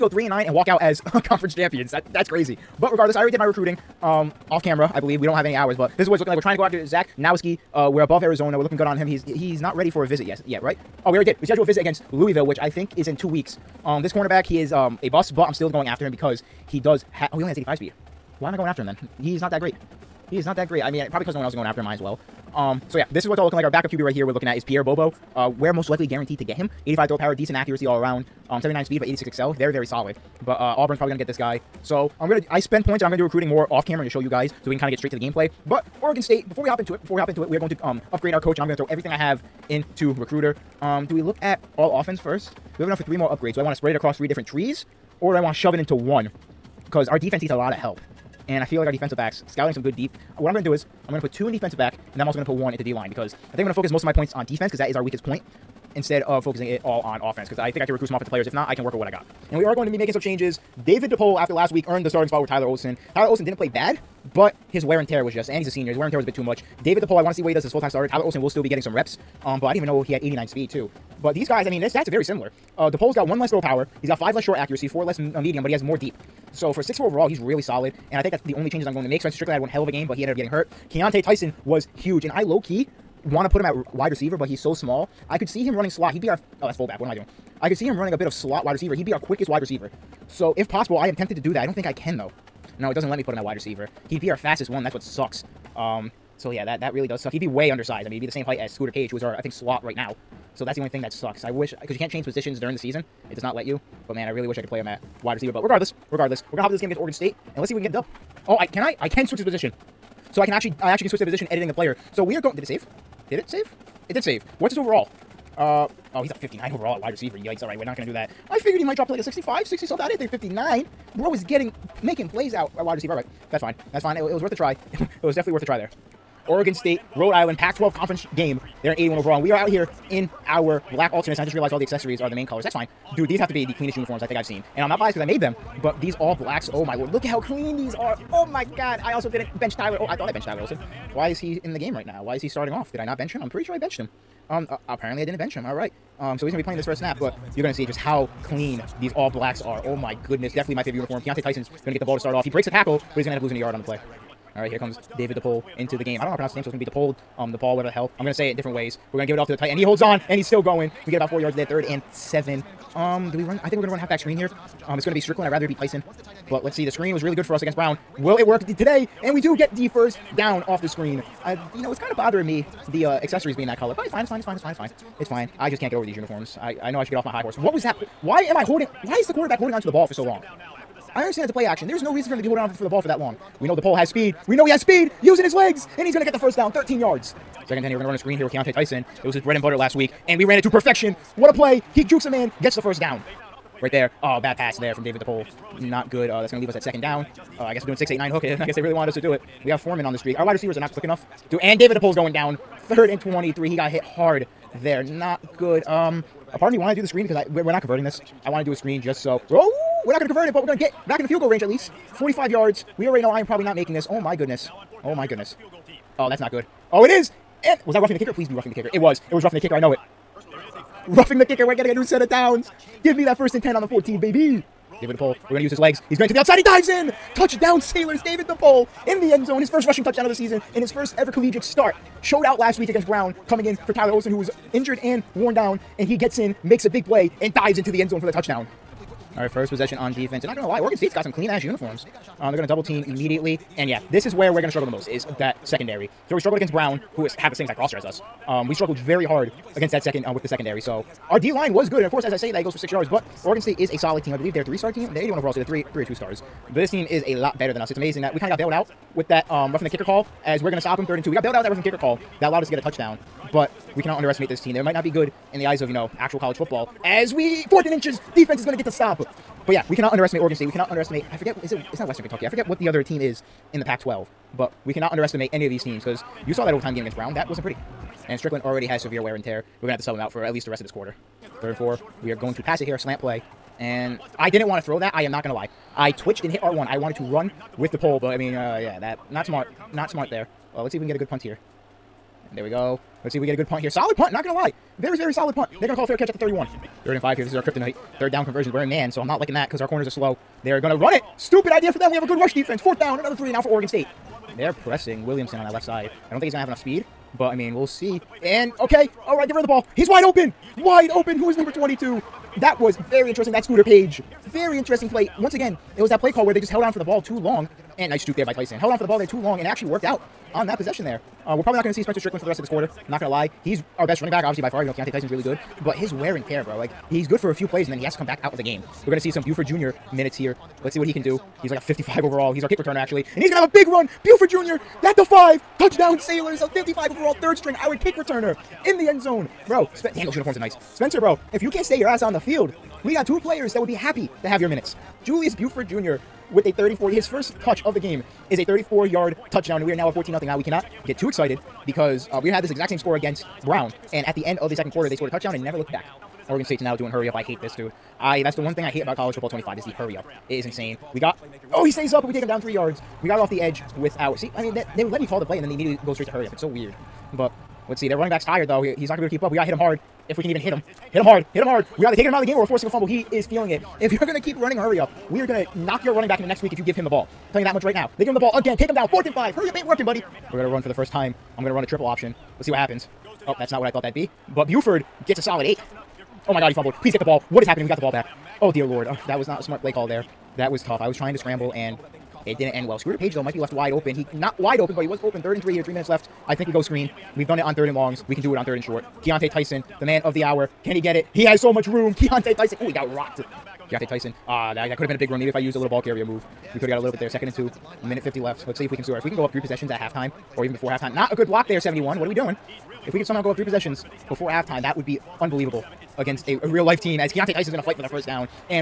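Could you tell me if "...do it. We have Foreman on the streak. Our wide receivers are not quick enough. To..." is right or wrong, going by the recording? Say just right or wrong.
right.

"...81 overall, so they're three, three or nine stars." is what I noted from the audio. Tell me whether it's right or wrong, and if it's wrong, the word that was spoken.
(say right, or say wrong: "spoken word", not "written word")
wrong: "two", not "nine".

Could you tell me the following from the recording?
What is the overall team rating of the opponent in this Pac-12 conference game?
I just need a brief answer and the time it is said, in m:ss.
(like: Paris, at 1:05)
81, at 2:08.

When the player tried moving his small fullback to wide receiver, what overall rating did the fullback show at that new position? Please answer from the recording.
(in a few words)
59.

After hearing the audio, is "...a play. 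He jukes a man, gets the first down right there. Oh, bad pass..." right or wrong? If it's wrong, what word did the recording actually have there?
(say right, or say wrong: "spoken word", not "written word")
right.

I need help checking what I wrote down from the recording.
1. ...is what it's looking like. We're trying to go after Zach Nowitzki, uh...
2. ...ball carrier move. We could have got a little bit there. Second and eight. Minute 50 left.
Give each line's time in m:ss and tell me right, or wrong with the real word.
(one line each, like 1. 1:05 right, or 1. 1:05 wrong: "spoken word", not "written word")
1. 0:06 right
2. 6:45 wrong: "two", not "eight".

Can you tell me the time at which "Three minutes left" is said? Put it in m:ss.
6:35.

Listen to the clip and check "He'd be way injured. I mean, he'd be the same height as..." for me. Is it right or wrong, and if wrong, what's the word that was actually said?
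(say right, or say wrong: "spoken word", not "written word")
wrong: "undersized", not "injured".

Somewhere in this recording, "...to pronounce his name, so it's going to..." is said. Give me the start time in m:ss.
2:36.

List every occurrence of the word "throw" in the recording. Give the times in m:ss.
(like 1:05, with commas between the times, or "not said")
0:27, 0:38, 1:13, 4:44.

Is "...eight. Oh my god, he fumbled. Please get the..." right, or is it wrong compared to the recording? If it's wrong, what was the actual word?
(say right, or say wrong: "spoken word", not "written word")
right.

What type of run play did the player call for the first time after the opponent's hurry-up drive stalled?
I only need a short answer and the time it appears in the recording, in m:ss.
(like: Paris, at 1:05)
Triple option, at 6:21.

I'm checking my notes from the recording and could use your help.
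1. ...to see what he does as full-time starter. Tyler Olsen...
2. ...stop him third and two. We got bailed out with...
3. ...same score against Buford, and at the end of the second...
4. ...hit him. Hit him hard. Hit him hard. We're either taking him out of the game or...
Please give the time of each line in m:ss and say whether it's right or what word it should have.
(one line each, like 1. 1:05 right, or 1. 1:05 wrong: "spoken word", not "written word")
1. 1:07 right
2. 4:20 right
3. 5:52 wrong: "Brown", not "Buford"
4. 6:10 right.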